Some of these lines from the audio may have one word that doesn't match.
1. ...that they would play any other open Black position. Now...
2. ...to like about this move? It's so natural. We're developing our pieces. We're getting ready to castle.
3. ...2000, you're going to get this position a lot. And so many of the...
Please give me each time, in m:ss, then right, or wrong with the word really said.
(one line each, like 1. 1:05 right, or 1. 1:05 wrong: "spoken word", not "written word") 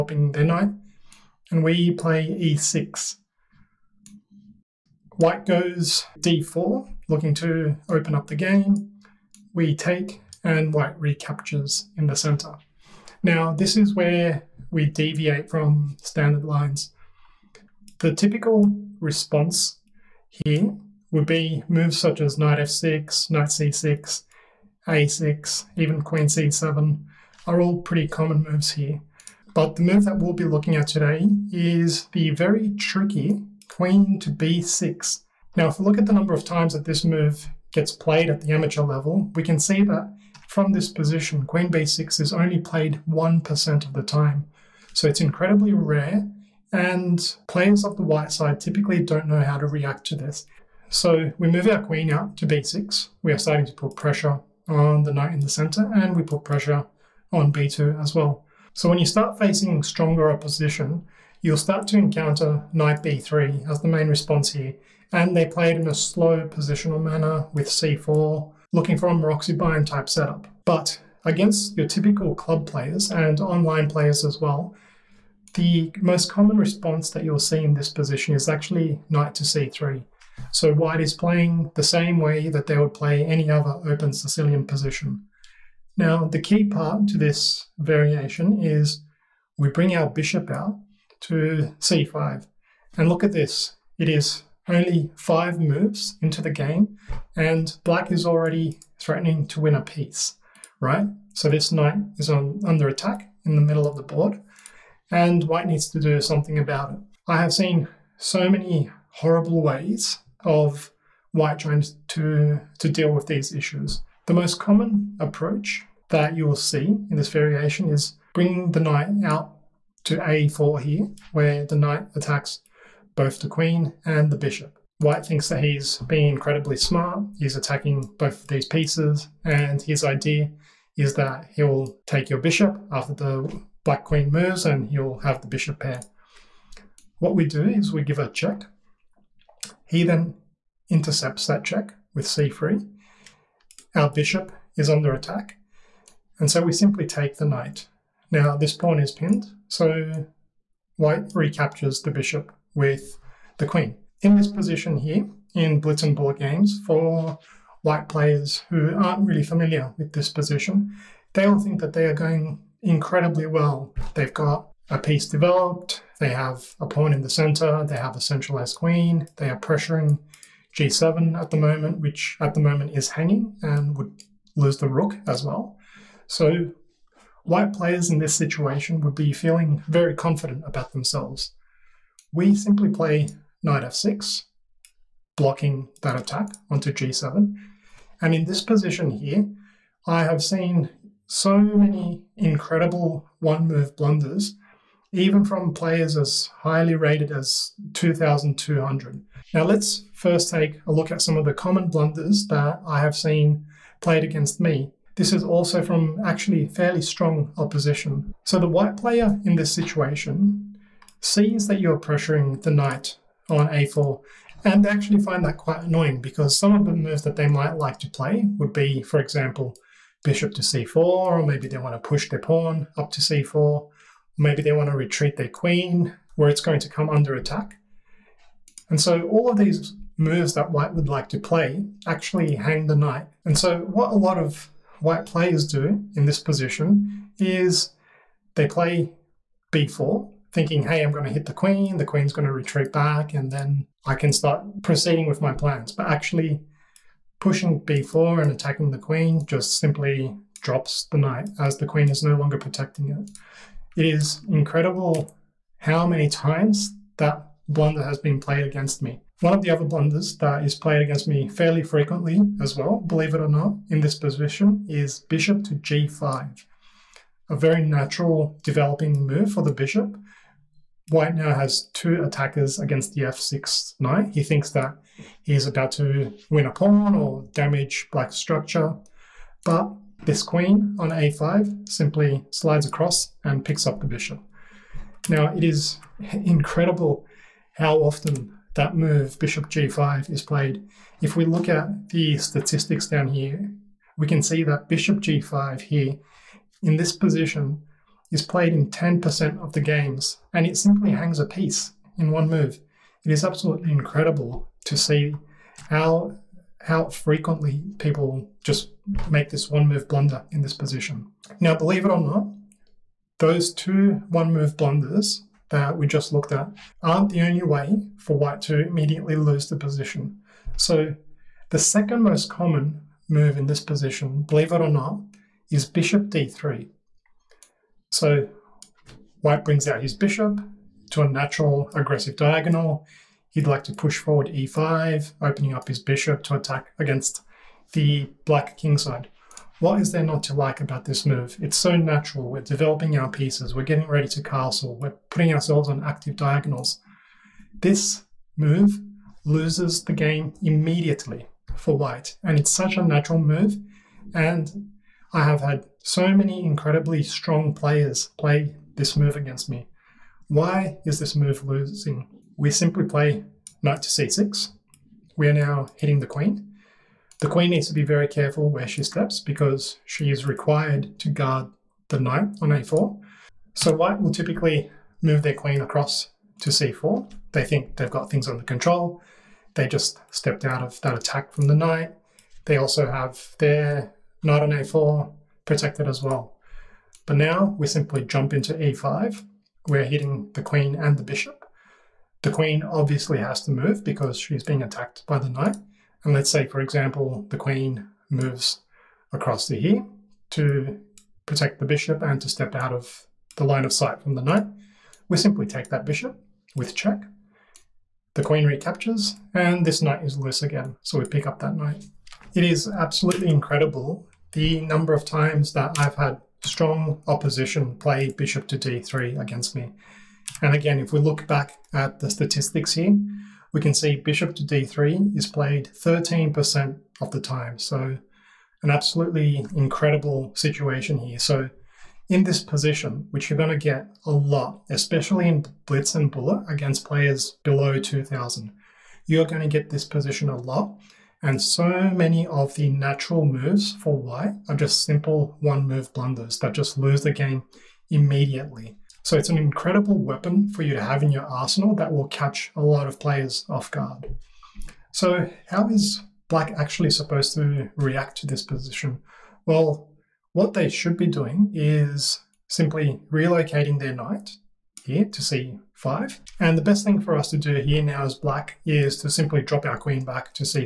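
1. 1:22 wrong: "Sicilian", not "Black"
2. 5:40 right
3. 7:17 right.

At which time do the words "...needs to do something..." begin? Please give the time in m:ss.
1:45.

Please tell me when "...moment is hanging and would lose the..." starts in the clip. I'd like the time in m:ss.
2:52.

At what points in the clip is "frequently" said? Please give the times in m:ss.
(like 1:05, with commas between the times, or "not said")
4:21, 5:07.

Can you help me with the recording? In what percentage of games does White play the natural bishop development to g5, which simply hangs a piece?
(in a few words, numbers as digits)
10%.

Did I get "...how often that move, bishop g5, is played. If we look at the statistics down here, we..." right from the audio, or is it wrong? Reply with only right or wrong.
right.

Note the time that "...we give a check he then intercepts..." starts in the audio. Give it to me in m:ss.
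2:17.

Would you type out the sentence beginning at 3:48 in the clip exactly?
And so all of these moves that white would like to play actually hang the knight.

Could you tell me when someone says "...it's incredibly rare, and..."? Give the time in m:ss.
0:45.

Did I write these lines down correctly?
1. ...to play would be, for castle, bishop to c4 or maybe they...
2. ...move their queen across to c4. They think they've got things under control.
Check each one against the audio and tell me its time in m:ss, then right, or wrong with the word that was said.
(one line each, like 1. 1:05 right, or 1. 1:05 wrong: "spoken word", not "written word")
1. 3:37 wrong: "example", not "castle"
2. 6:15 right.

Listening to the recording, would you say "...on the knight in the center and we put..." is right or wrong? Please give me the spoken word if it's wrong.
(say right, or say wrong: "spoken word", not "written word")
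right.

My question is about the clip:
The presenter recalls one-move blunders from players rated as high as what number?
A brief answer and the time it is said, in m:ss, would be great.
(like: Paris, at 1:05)
2200, at 3:17.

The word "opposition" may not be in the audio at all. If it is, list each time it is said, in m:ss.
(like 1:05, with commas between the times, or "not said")
1:00, 3:27, 6:57.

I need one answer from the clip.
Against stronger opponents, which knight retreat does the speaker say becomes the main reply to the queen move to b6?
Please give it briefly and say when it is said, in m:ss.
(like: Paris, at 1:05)
Knight b3, at 1:02.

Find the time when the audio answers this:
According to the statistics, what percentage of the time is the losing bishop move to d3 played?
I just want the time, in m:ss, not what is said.
7:05.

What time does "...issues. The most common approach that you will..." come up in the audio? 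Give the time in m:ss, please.
1:53.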